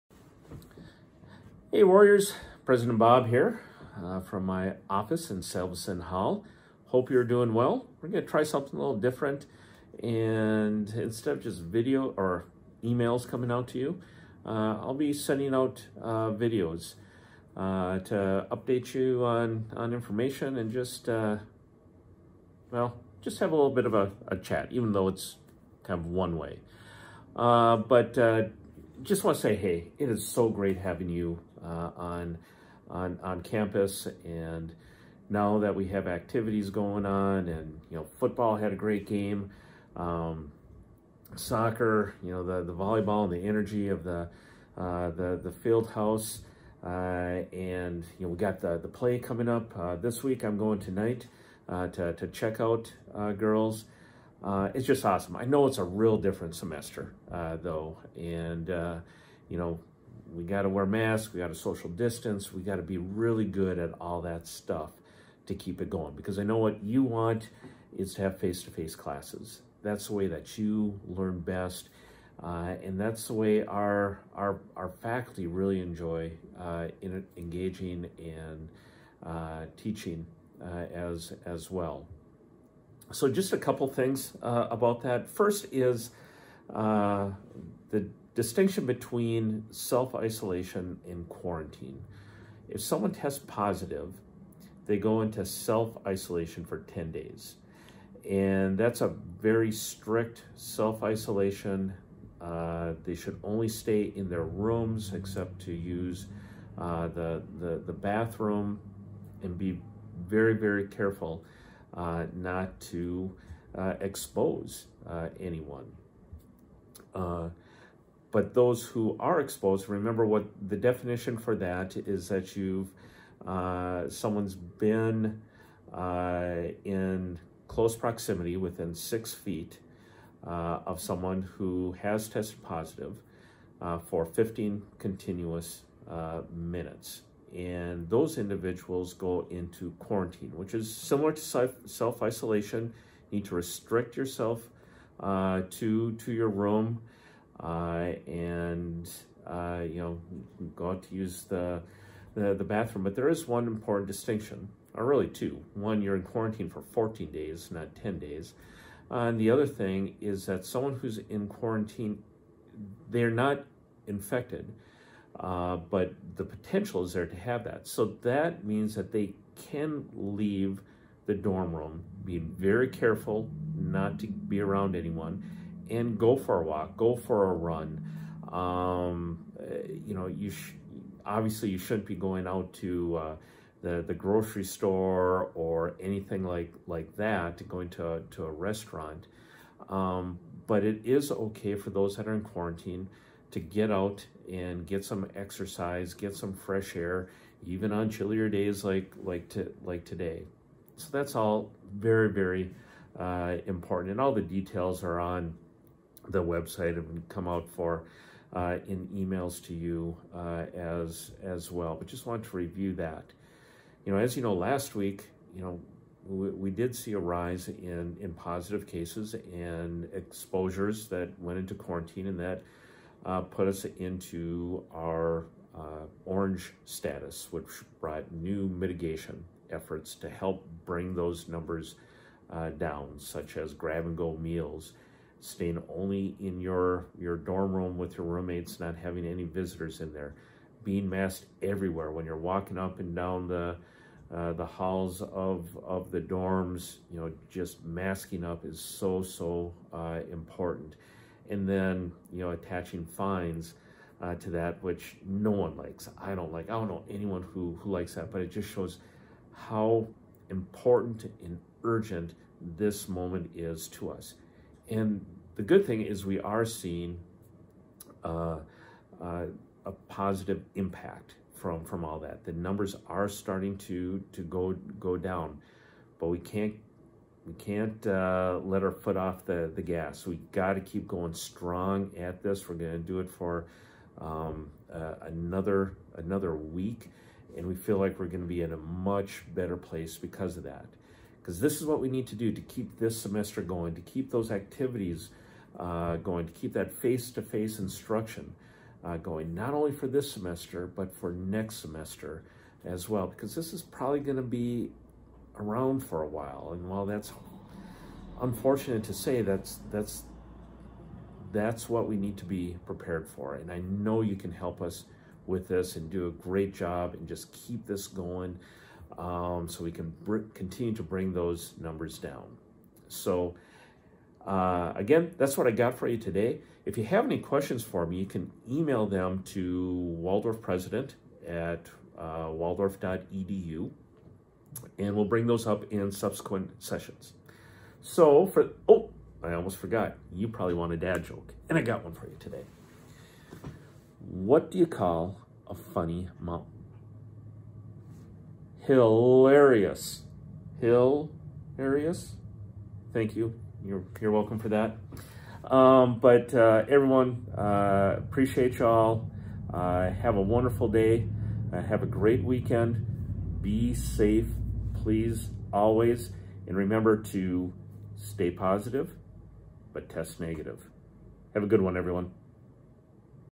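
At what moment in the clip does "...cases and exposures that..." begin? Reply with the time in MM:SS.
03:38.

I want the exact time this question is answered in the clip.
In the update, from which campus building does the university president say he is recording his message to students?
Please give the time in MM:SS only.
00:05.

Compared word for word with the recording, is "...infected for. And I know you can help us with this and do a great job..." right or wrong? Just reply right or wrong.
wrong.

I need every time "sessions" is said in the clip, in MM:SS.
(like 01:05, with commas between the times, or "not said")
05:36.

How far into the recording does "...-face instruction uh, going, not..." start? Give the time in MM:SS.
04:57.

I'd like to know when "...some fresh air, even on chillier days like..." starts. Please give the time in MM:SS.
03:16.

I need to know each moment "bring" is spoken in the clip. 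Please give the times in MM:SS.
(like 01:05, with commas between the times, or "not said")
03:50, 05:21, 05:35.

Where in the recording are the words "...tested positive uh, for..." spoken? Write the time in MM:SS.
02:12.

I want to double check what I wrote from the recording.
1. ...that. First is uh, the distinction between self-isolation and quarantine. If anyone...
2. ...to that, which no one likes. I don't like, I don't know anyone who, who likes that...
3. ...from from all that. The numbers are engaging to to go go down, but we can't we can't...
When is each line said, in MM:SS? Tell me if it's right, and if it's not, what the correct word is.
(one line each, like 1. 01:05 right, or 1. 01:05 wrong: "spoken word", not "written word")
1. 01:25 wrong: "someone", not "anyone"
2. 04:14 right
3. 04:31 wrong: "starting", not "engaging".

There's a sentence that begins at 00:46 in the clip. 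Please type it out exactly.
Uh, and, you know, we got the, the play coming up uh, this week.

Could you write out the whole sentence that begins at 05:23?
So uh, again, that's what I got for you today.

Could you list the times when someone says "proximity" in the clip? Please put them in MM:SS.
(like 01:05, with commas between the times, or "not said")
02:07.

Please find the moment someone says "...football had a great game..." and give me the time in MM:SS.
00:38.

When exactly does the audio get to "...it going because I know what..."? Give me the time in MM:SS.
01:05.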